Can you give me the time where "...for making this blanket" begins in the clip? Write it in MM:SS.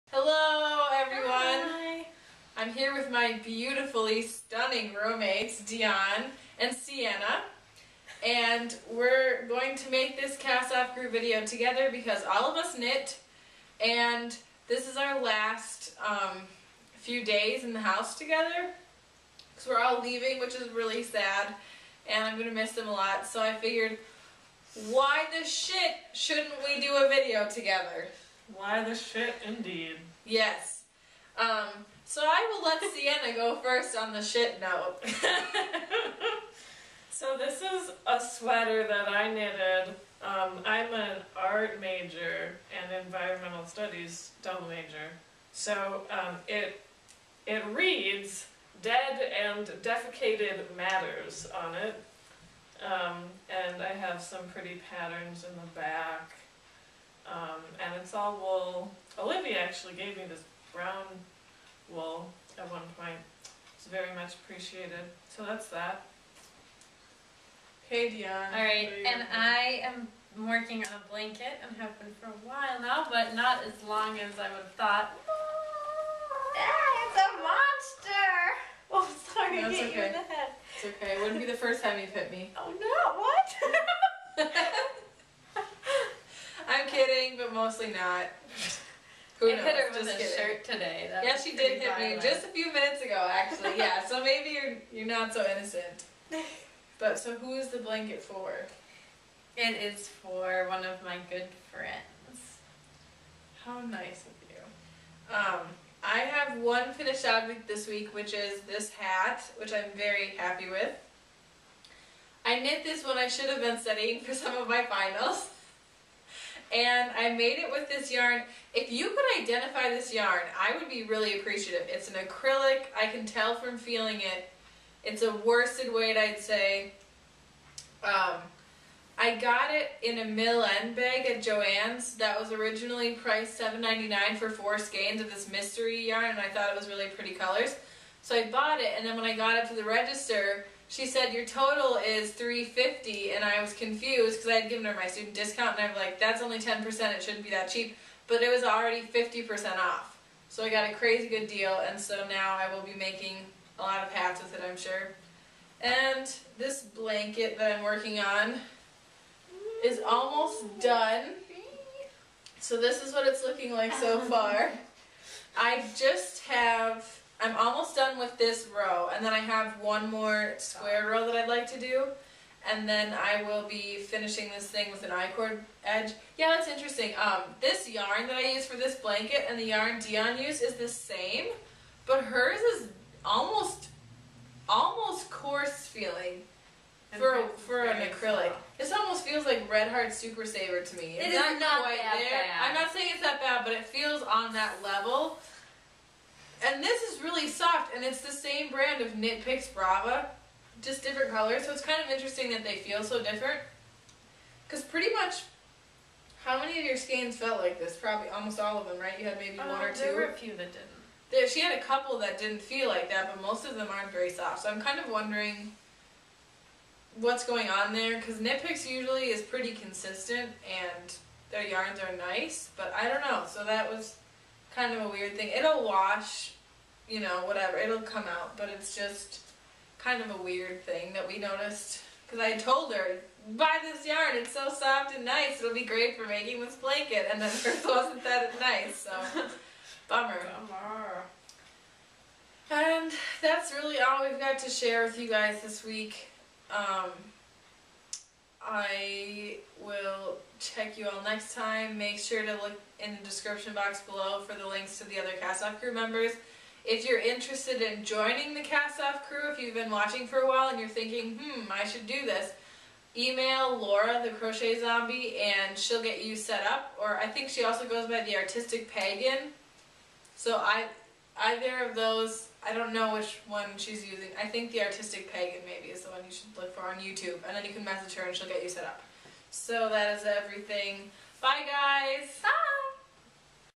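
03:56.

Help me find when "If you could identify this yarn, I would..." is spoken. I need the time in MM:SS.
01:58.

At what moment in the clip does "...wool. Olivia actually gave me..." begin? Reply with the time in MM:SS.
00:58.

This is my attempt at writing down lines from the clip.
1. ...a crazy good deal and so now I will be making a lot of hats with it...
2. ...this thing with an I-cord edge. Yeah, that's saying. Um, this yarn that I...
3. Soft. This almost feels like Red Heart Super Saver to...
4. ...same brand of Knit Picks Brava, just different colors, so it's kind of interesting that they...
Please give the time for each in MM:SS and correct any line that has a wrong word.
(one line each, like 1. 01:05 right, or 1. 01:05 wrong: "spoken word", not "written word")
1. 02:30 right
2. 02:54 wrong: "interesting", not "saying"
3. 03:08 right
4. 03:18 right.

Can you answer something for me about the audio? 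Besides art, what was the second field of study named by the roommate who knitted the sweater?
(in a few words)
Environmental studies.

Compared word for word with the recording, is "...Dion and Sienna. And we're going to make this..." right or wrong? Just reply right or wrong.
right.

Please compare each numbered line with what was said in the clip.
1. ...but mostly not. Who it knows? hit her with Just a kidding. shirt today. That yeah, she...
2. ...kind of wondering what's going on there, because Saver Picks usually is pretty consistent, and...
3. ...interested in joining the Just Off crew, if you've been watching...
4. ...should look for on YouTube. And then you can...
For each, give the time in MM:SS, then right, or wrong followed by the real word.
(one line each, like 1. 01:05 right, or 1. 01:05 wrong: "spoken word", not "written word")
1. 01:27 right
2. 03:34 wrong: "Knit", not "Saver"
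3. 04:17 wrong: "Cast", not "Just"
4. 04:36 right.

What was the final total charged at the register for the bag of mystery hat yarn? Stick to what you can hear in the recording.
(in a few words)
$3.50.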